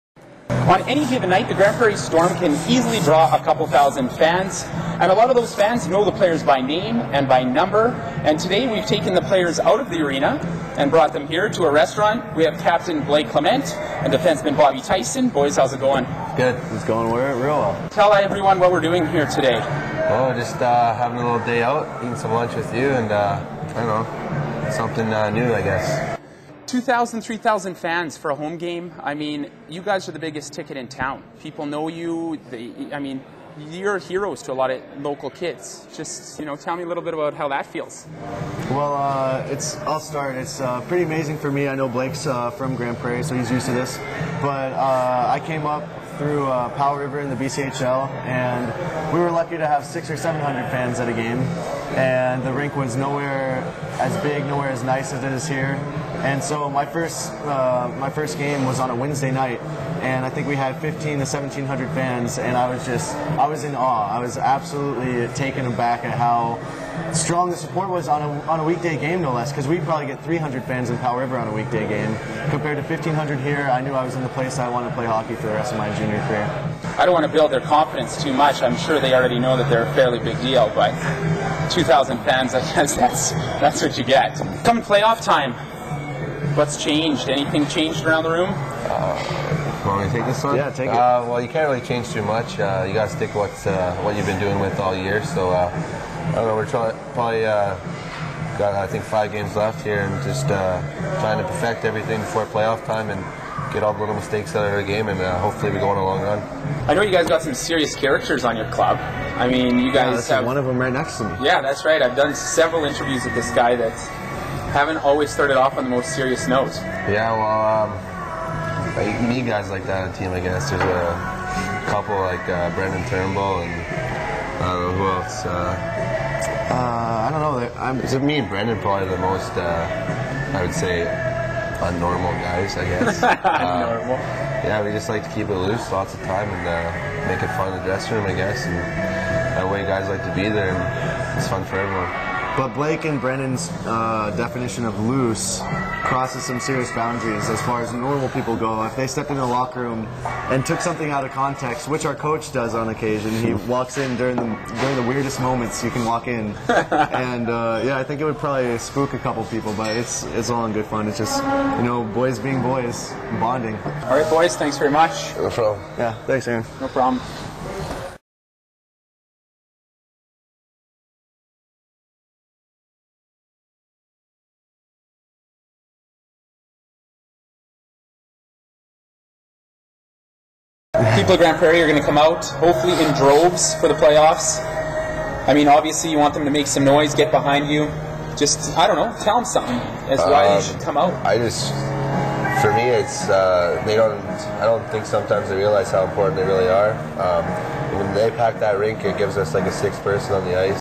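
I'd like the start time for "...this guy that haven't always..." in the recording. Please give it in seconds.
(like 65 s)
113 s.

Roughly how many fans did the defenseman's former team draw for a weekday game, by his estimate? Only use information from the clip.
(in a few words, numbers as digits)
300.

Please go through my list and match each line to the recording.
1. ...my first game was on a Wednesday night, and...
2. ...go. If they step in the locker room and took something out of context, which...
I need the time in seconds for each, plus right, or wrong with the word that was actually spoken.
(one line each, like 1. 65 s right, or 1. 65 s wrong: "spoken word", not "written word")
1. 57 s right
2. 148 s right.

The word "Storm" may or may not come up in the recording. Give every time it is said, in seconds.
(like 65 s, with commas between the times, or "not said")
1 s.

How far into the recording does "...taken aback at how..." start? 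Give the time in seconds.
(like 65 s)
65 s.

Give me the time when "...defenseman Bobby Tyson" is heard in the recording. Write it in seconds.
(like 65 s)
14 s.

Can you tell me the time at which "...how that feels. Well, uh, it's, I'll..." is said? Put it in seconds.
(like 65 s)
37 s.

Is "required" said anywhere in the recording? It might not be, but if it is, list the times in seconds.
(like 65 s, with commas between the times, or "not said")
not said.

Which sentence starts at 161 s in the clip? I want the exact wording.
It's just you know boys being boys, bonding.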